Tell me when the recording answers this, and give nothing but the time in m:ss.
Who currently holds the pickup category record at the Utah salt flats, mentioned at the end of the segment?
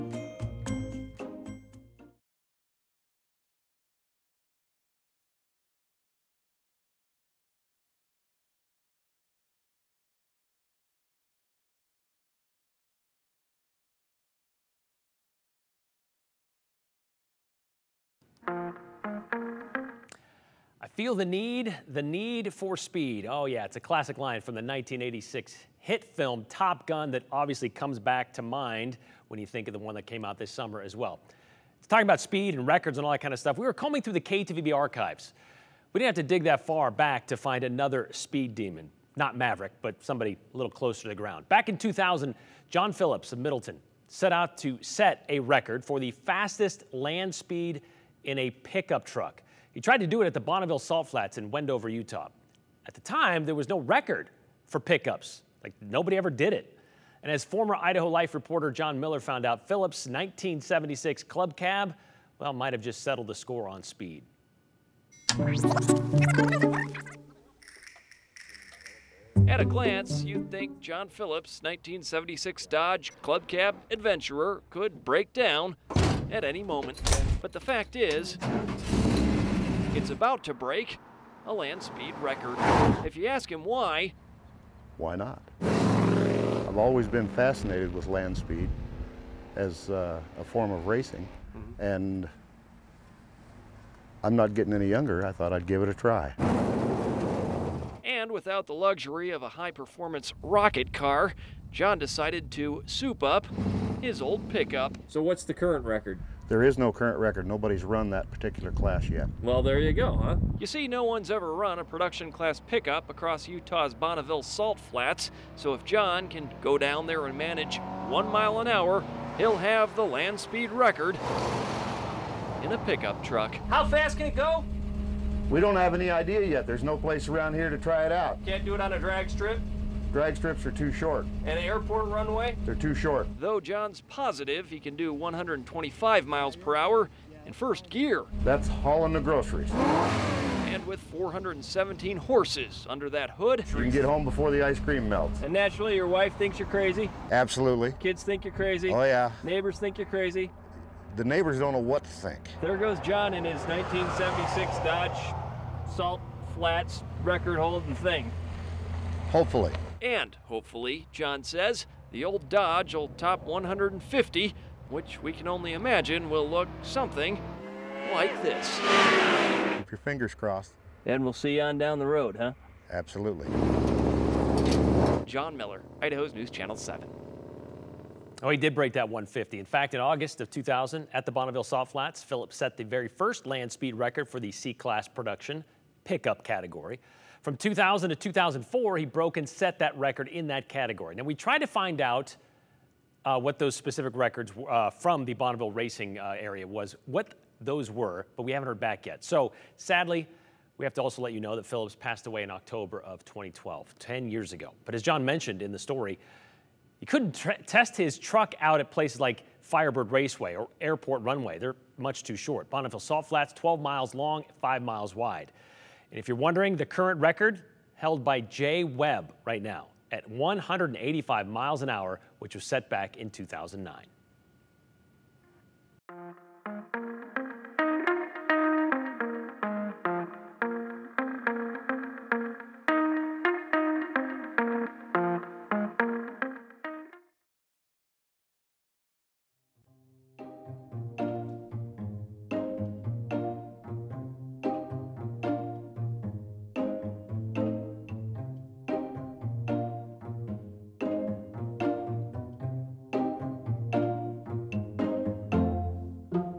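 3:38.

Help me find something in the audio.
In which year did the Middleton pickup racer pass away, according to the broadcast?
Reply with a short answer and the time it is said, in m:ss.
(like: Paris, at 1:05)
2012, at 3:22.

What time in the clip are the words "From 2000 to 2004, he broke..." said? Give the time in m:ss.
3:07.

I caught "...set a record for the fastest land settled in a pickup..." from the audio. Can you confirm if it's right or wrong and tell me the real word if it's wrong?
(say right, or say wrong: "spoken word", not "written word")
wrong: "speed", not "settled".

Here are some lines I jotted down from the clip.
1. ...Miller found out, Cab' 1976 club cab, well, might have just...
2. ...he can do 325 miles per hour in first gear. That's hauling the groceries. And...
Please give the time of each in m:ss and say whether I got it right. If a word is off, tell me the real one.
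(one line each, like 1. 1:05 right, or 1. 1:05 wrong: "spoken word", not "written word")
1. 0:58 wrong: "Phillips", not "Cab"
2. 2:14 wrong: "125", not "325".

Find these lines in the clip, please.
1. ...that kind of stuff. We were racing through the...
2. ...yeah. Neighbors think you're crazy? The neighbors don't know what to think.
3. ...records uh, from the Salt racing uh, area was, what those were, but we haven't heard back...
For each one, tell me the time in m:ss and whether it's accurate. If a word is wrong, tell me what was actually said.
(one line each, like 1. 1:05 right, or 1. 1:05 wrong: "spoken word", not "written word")
1. 0:33 wrong: "combing", not "racing"
2. 2:29 right
3. 3:14 wrong: "Bonneville", not "Salt".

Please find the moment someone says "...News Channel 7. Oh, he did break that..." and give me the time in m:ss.
2:56.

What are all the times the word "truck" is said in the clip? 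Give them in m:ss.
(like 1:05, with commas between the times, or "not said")
0:49, 2:03, 3:28.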